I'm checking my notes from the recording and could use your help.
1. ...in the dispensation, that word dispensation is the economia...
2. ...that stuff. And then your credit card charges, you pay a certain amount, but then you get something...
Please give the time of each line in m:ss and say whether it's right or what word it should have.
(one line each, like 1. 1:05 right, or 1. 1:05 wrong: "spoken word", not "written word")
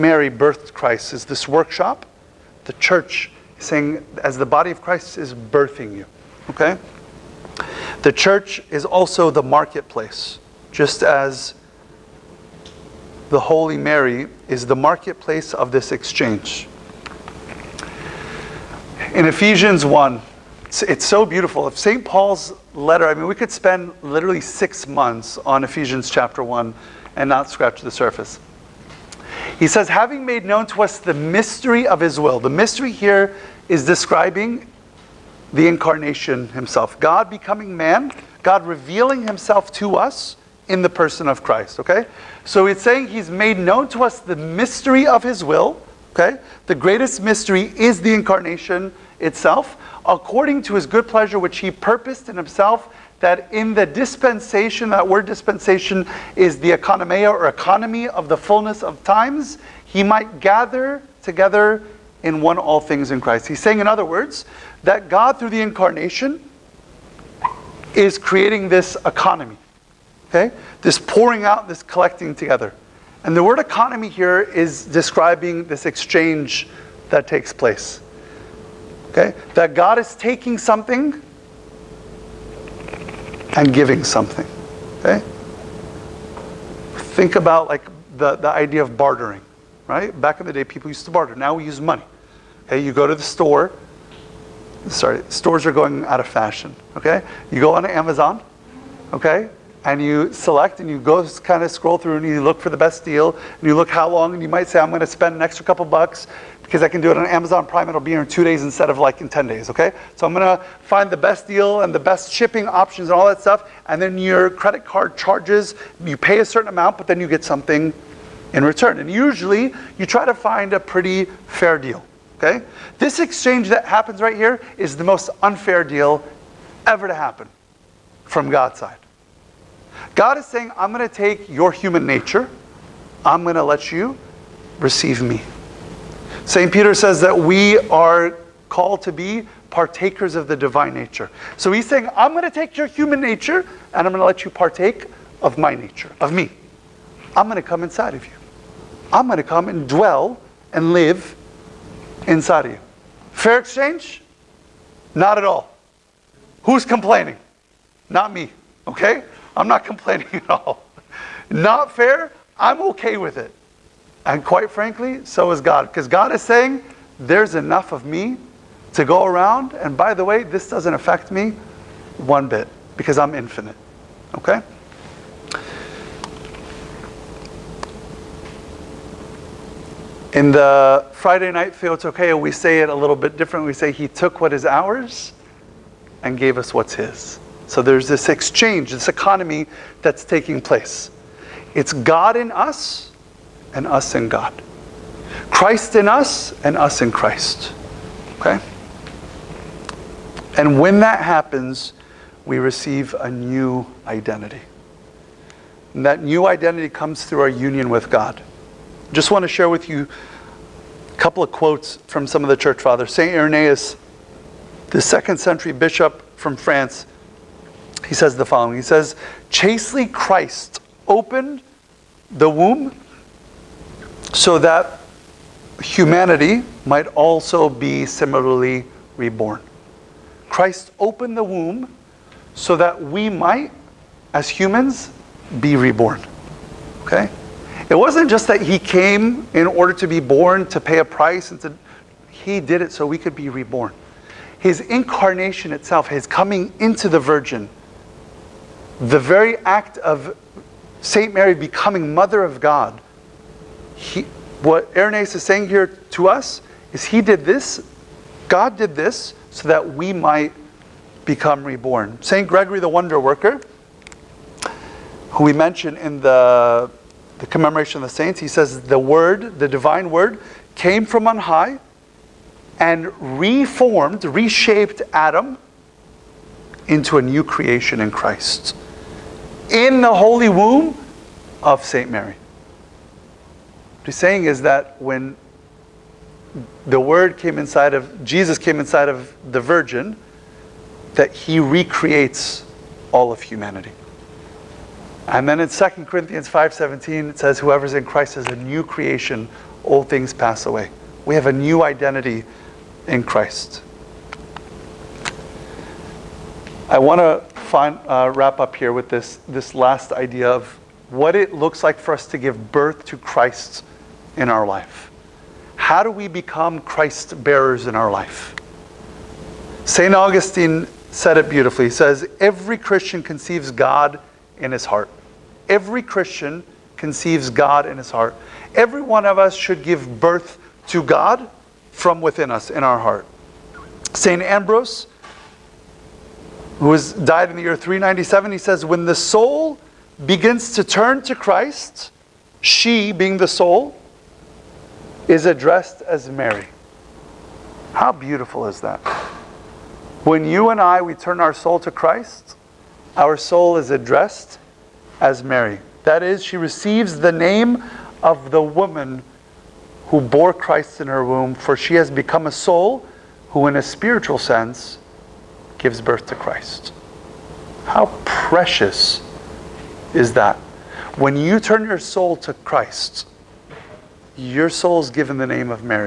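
1. 0:53 right
2. 1:53 right.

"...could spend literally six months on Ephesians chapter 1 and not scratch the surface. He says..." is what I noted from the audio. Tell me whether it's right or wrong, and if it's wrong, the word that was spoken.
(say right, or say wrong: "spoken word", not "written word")
right.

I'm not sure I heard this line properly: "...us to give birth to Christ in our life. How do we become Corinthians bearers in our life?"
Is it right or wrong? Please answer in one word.
wrong.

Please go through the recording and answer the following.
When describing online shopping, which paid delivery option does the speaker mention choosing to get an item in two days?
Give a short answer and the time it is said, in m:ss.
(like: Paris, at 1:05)
Amazon Prime, at 1:47.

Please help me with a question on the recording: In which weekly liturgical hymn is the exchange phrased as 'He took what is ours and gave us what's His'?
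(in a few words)
Friday night Theotokia.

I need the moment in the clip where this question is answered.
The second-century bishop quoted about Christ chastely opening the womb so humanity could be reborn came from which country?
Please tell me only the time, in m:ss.
3:36.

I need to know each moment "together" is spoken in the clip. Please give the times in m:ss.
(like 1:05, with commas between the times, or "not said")
1:01, 1:12.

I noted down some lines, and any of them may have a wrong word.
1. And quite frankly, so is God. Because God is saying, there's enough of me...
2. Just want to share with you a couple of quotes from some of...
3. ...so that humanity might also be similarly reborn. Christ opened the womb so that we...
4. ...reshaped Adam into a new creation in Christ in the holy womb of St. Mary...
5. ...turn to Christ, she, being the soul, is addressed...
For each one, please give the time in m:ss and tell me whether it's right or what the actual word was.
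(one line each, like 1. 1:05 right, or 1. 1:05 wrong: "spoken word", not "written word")
1. 2:44 right
2. 3:29 right
3. 3:44 right
4. 4:34 right
5. 5:40 right.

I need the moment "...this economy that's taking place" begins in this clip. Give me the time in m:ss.
3:08.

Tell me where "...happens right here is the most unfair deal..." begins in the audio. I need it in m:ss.
2:03.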